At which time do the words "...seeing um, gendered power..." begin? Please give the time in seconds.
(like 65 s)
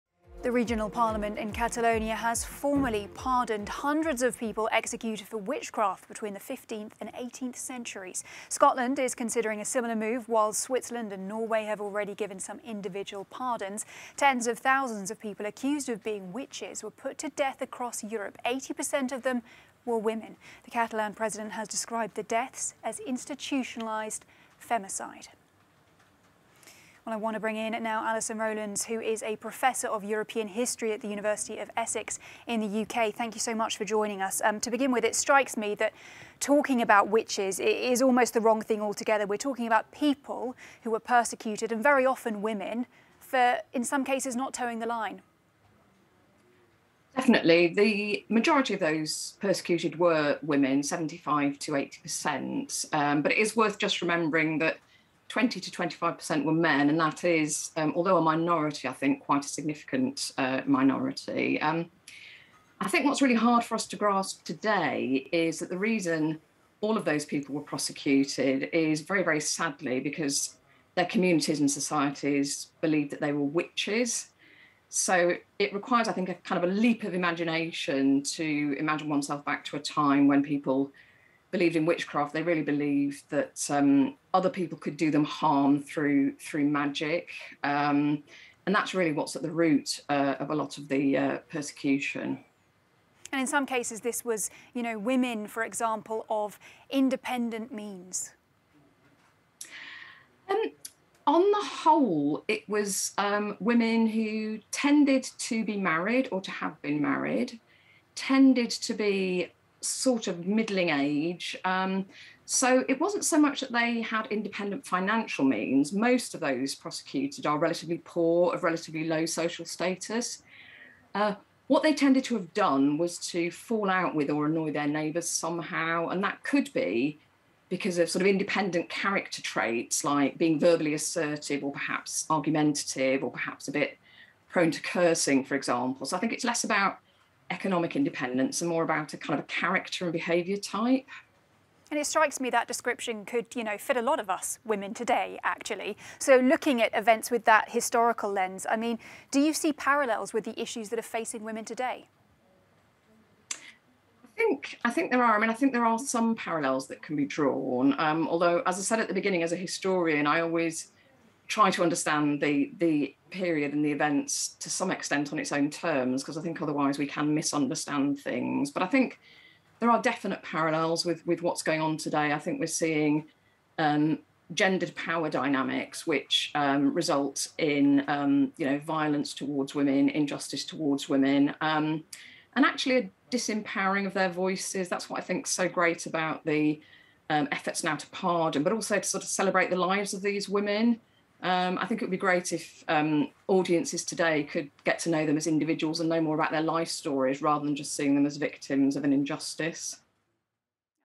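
172 s.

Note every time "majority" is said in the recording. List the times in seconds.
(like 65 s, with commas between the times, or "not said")
48 s.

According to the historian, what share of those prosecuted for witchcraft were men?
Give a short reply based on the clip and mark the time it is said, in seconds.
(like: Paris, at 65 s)
20 to 25%, at 55 s.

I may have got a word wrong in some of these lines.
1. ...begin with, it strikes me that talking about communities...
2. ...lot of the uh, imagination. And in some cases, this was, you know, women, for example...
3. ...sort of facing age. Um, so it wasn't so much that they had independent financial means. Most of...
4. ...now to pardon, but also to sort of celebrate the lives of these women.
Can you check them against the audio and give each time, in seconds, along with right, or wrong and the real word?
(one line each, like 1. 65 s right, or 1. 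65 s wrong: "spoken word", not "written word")
1. 34 s wrong: "witches", not "communities"
2. 90 s wrong: "persecution", not "imagination"
3. 109 s wrong: "middling", not "facing"
4. 187 s right.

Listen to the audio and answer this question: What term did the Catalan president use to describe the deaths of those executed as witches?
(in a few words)
institutionalised femicide.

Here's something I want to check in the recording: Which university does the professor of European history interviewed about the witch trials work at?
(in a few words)
University of Essex.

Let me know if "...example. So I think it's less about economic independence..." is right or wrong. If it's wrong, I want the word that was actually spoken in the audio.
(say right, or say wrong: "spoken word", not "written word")
right.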